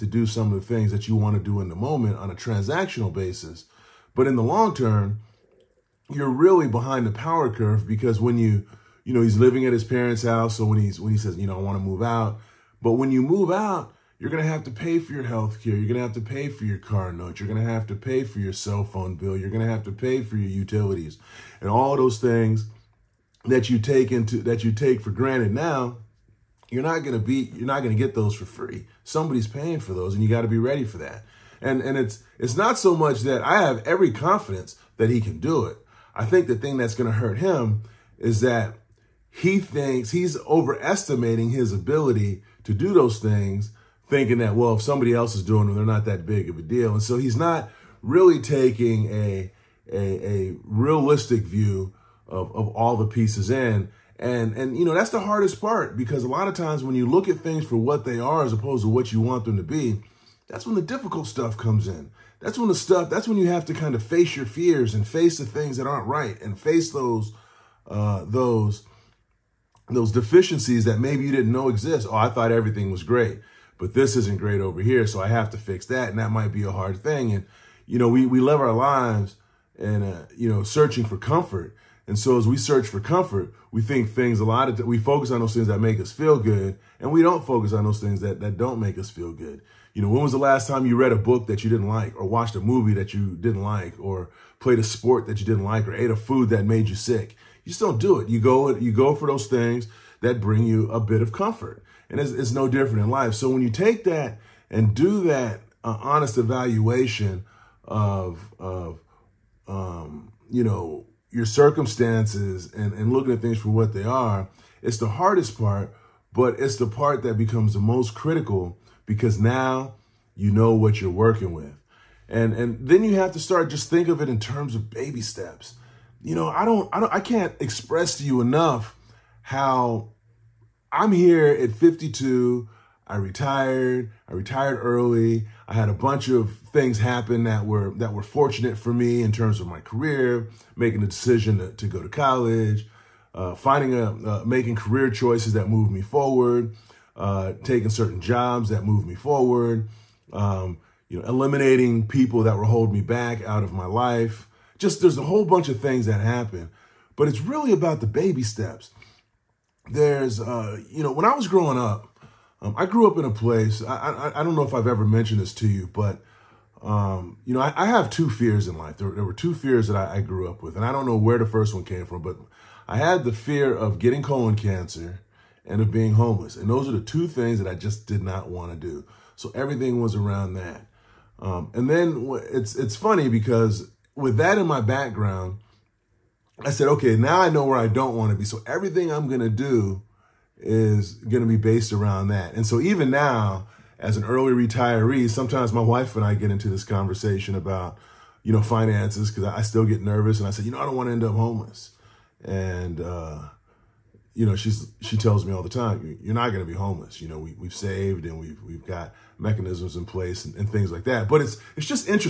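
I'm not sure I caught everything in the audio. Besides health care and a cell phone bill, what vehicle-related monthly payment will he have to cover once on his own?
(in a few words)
car note.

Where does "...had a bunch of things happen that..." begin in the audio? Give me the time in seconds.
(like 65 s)
135 s.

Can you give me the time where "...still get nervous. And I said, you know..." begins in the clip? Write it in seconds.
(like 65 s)
199 s.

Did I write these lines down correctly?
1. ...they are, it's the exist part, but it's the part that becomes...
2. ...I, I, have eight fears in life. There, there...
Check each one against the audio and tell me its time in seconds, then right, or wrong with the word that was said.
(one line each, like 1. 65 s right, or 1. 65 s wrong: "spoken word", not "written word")
1. 113 s wrong: "hardest", not "exist"
2. 167 s wrong: "two", not "eight".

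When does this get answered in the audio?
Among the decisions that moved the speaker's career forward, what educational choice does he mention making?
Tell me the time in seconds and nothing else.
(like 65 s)
141 s.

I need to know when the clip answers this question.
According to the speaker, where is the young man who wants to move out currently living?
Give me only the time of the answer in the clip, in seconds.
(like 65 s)
9 s.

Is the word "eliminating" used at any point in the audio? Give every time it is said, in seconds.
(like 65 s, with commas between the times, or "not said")
151 s.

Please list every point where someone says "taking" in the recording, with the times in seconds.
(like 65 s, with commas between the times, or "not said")
48 s, 147 s.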